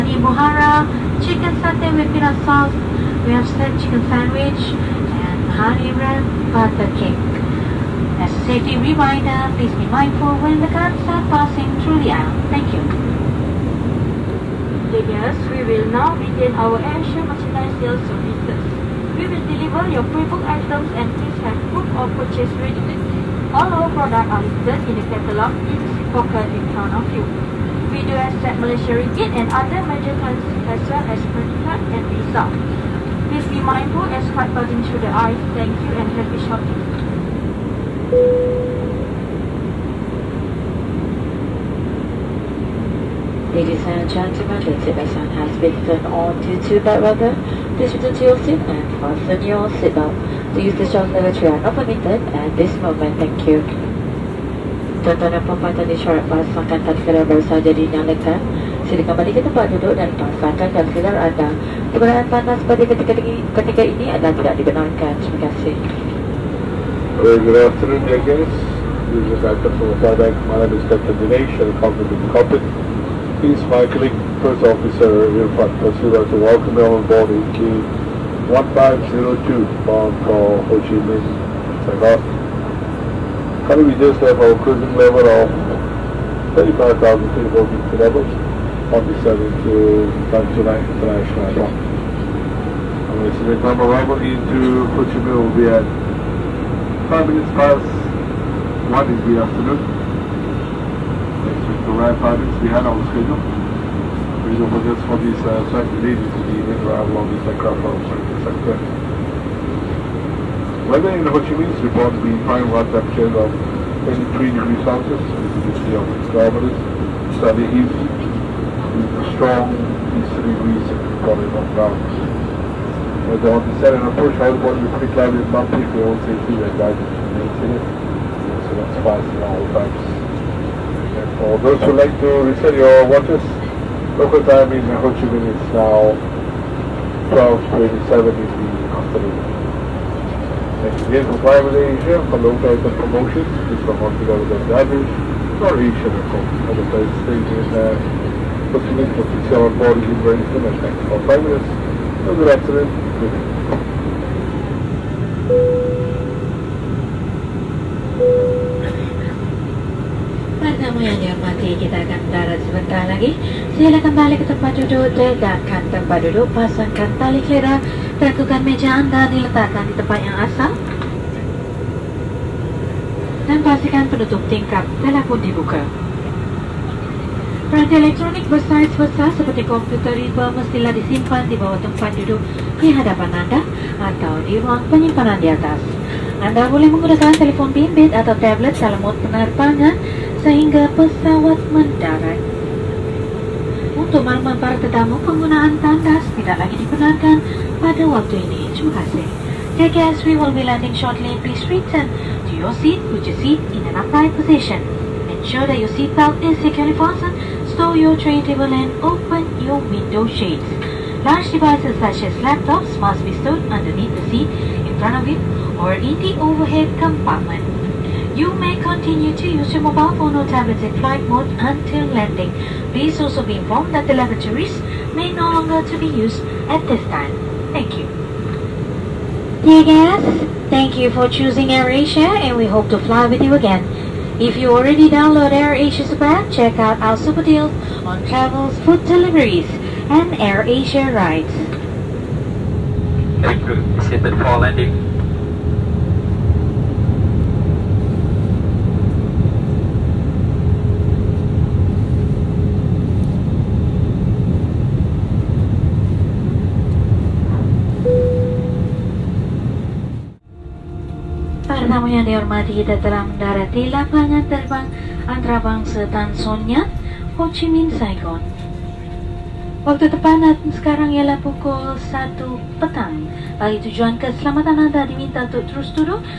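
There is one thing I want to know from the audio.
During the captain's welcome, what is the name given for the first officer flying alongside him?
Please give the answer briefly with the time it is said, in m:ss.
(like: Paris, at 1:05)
Irfan Pasura, at 1:15.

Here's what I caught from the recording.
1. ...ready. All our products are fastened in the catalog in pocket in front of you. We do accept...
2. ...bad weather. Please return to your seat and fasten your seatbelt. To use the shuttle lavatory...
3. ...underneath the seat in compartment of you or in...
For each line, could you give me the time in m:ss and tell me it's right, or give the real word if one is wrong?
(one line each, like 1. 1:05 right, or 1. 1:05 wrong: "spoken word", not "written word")
1. 0:22 wrong: "listed", not "fastened"
2. 0:46 right
3. 3:33 wrong: "front", not "compartment".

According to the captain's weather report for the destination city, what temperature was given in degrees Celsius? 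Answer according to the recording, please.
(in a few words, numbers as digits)
23.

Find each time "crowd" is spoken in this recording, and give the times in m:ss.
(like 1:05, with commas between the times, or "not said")
not said.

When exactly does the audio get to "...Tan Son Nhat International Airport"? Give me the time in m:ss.
1:30.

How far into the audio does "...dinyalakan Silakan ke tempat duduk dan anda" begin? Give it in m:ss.
0:57.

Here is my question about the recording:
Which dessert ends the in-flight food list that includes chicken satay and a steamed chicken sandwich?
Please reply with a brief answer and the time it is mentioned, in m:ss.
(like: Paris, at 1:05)
Hariram Butter Cake, at 0:05.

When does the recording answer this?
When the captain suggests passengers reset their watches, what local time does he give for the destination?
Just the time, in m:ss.
2:17.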